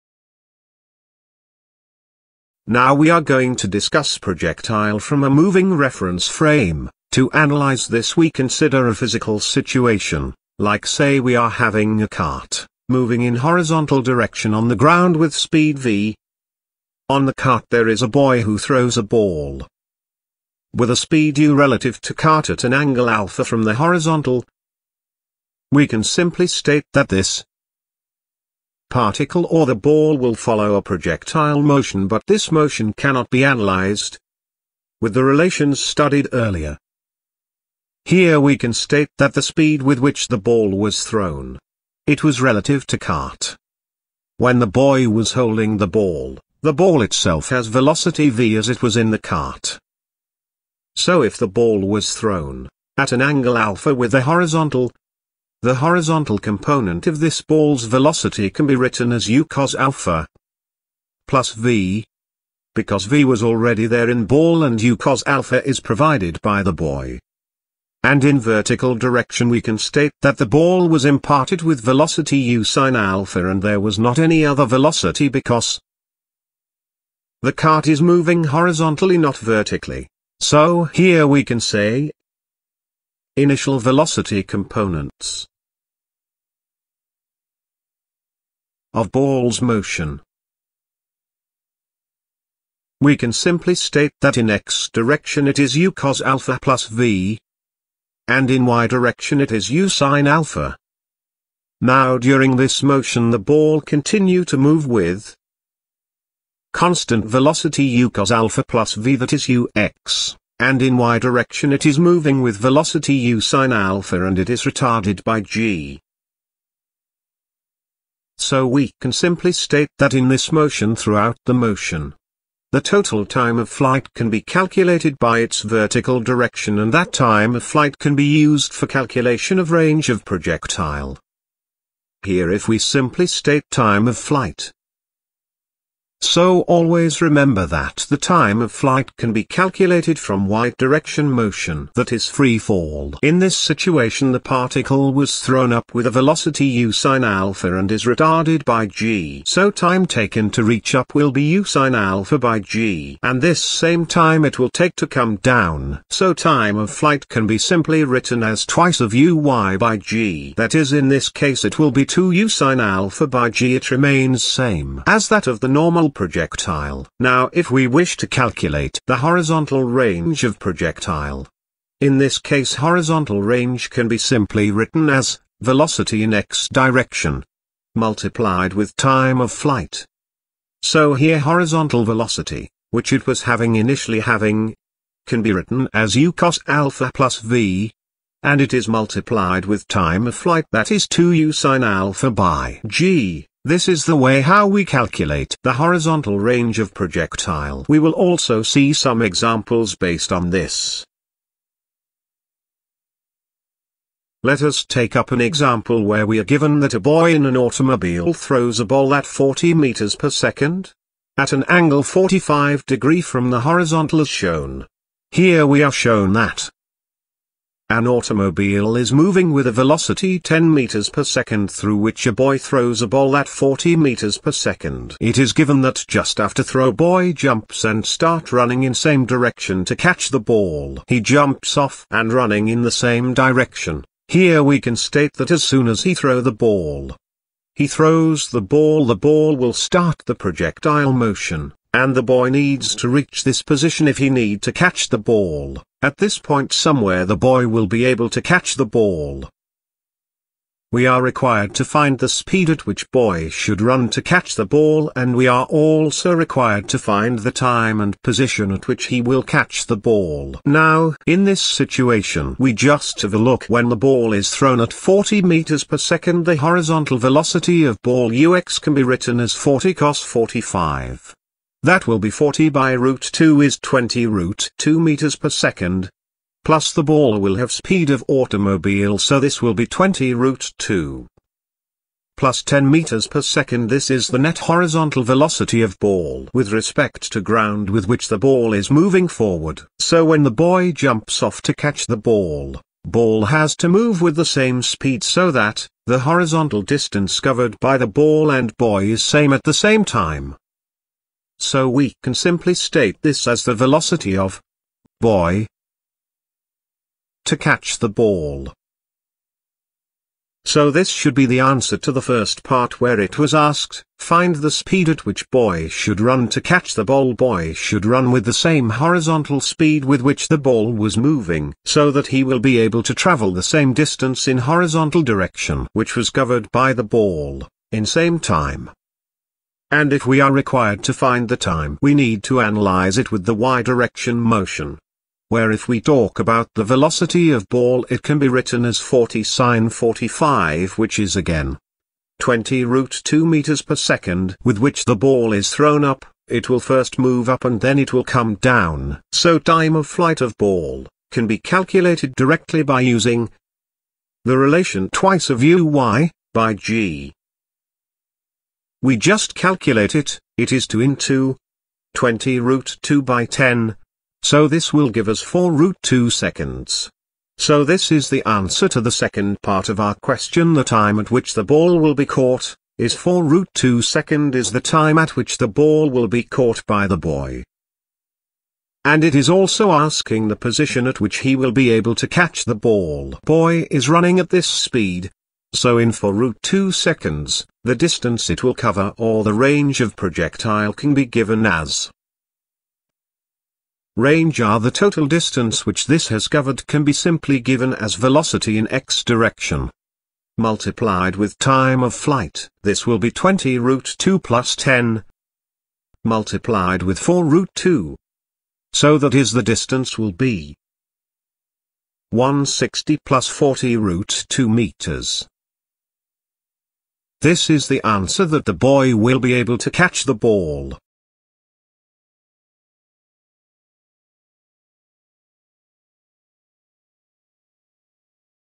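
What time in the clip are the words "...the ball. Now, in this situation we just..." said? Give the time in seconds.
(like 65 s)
259 s.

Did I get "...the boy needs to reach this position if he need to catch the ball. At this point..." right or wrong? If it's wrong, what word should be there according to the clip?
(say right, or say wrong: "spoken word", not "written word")
right.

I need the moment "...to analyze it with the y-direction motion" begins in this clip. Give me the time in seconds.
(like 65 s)
332 s.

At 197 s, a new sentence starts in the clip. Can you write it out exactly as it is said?
We will also see some examples based on this.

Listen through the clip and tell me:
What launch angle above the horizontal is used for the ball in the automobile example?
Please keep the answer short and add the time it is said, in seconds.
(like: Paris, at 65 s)
45 degrees, at 212 s.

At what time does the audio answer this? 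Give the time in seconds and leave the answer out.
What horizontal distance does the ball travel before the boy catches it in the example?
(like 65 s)
412 s.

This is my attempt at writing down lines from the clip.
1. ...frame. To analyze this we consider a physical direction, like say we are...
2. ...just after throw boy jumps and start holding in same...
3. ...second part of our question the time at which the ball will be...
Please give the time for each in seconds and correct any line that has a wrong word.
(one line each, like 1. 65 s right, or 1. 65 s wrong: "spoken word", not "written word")
1. 6 s wrong: "situation", not "direction"
2. 226 s wrong: "running", not "holding"
3. 369 s right.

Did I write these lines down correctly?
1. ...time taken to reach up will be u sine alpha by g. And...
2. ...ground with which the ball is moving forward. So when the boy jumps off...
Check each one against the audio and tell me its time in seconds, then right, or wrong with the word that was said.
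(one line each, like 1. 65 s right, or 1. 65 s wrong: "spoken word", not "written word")
1. 149 s right
2. 287 s right.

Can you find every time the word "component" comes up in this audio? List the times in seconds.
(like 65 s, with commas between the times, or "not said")
56 s, 84 s.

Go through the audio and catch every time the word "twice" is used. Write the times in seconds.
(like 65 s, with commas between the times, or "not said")
158 s, 355 s.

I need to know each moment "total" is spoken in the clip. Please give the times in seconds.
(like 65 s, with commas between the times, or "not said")
122 s, 394 s.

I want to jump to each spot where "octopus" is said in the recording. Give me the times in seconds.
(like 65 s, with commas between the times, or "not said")
not said.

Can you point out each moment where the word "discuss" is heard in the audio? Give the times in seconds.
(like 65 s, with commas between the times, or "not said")
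3 s.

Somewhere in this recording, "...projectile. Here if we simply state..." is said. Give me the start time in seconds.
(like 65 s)
130 s.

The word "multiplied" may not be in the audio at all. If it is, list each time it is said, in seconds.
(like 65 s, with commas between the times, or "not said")
177 s, 188 s, 400 s, 406 s.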